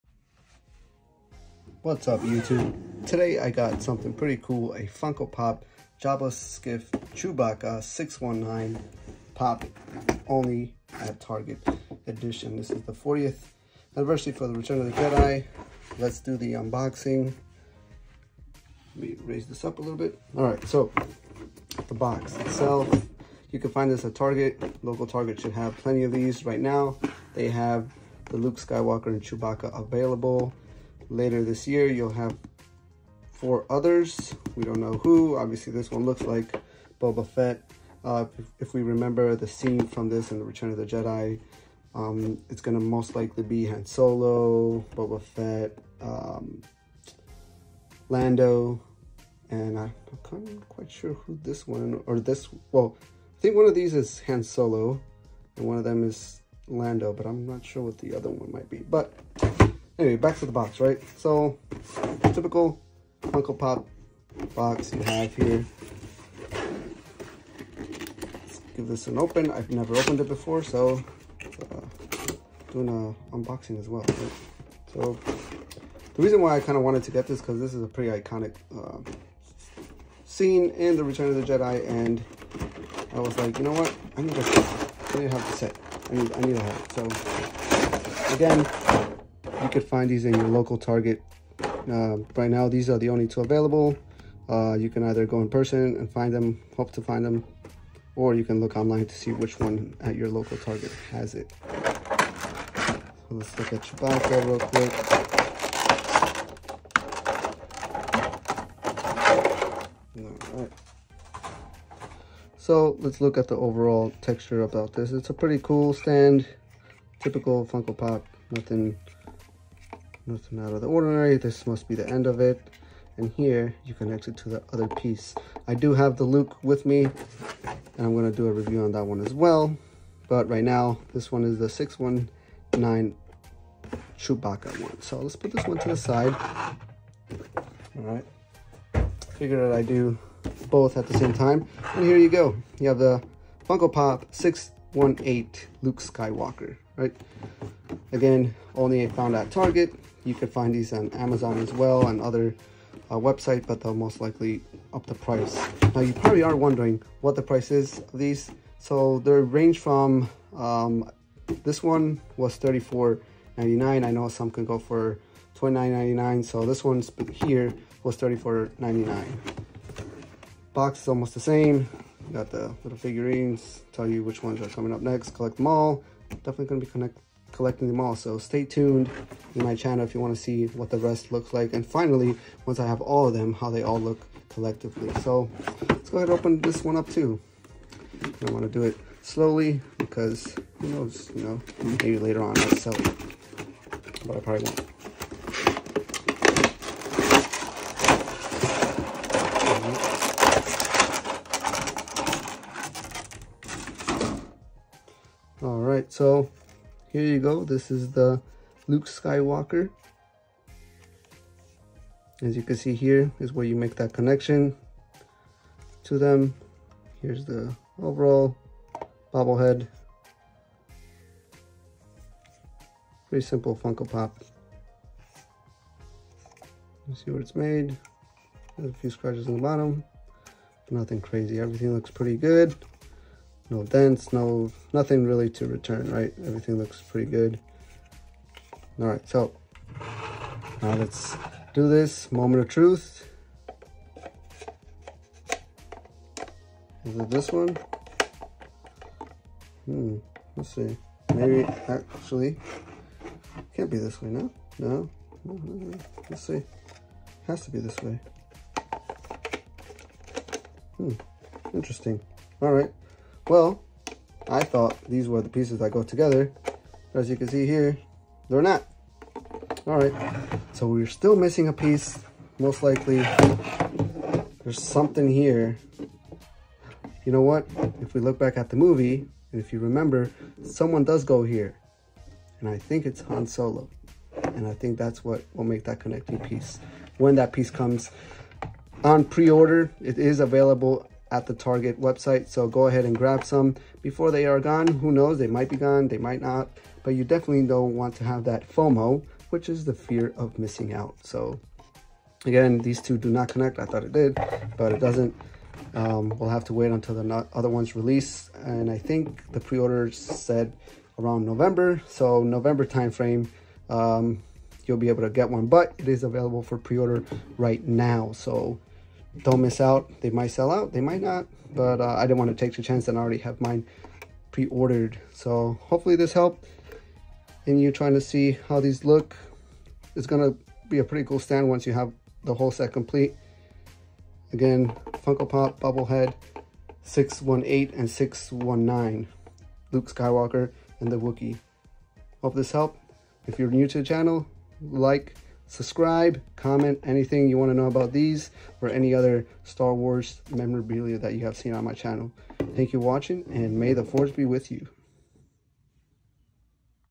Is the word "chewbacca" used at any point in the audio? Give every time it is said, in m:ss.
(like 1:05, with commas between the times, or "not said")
0:06, 0:29, 1:43, 2:14.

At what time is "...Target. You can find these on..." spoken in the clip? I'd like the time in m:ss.
2:29.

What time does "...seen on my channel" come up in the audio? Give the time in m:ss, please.
5:51.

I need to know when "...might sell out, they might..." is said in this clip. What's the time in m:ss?
5:20.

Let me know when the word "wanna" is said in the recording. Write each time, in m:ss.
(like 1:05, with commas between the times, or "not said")
3:00, 3:08.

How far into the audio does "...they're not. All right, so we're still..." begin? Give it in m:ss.
4:28.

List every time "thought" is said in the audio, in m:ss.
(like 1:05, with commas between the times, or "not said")
4:24, 5:03.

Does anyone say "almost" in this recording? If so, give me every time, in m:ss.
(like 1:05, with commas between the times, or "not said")
2:51.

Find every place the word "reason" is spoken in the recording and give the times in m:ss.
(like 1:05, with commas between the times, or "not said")
1:16.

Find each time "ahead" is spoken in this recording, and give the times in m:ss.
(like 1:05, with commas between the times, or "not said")
3:06, 4:52.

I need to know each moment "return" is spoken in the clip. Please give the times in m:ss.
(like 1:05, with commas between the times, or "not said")
0:14, 0:40, 1:21, 3:55.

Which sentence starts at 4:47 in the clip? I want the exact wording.
When that piece comes on pre-order, it is available at the Target website.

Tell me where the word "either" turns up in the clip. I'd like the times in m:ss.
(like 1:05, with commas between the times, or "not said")
1:35.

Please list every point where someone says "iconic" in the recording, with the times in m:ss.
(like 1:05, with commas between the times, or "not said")
1:18.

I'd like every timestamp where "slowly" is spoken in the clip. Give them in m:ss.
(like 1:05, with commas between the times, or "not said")
3:09.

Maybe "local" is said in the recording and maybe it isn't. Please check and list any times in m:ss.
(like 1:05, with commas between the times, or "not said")
0:24, 1:30, 1:40.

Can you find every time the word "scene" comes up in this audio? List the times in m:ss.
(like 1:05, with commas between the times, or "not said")
0:39, 1:20.